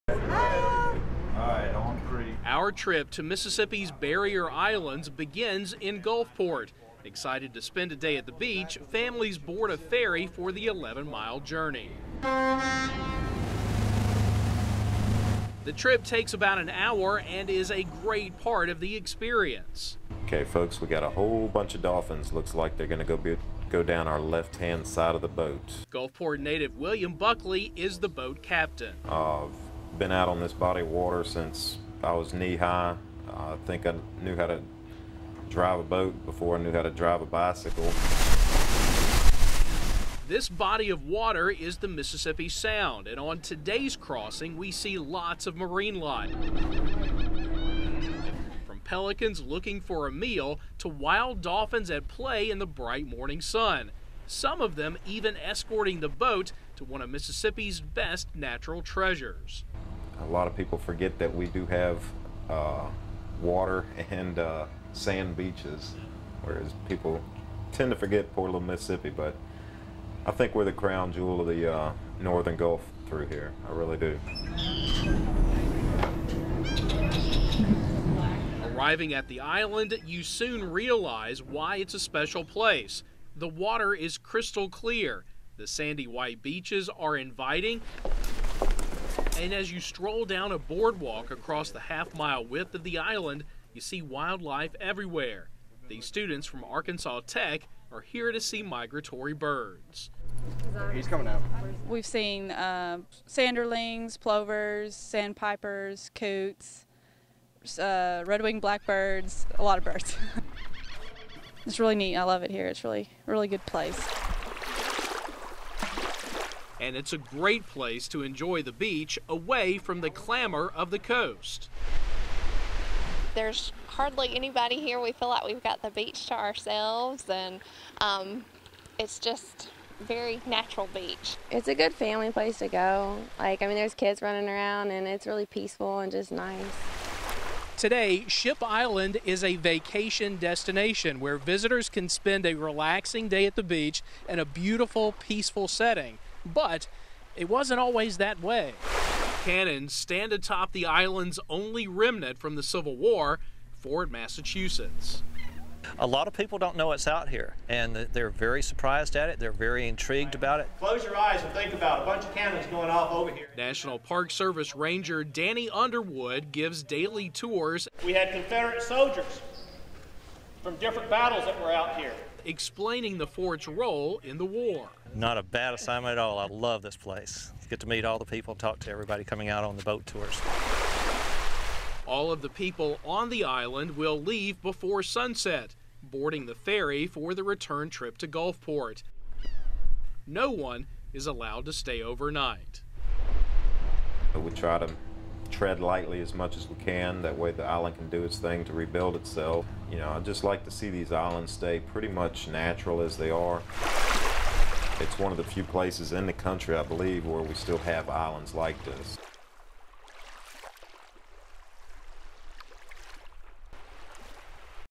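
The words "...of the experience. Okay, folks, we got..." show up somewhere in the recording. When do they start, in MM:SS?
00:18.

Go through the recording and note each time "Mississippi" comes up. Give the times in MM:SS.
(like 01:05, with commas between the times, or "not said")
00:03, 00:41, 00:57, 01:08.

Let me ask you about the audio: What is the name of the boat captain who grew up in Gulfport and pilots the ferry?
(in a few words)
William Buckley.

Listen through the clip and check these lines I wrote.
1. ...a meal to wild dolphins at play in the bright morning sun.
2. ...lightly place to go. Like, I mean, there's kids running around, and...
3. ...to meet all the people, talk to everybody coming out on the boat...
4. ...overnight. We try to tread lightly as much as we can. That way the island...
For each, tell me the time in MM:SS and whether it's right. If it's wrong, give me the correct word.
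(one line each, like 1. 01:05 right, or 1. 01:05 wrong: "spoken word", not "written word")
1. 00:50 right
2. 02:11 wrong: "family", not "lightly"
3. 02:57 right
4. 03:12 right.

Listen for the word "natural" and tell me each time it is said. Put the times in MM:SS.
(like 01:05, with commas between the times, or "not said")
00:58, 02:10, 03:22.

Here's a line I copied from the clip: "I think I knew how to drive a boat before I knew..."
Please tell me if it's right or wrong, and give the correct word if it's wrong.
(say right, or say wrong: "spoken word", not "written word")
right.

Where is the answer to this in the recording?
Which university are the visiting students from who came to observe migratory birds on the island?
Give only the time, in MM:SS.
01:36.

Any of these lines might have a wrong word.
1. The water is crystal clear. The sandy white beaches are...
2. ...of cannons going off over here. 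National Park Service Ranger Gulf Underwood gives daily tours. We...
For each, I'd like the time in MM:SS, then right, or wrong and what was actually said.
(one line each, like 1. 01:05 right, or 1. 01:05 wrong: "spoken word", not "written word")
1. 01:23 right
2. 02:42 wrong: "Danny", not "Gulf".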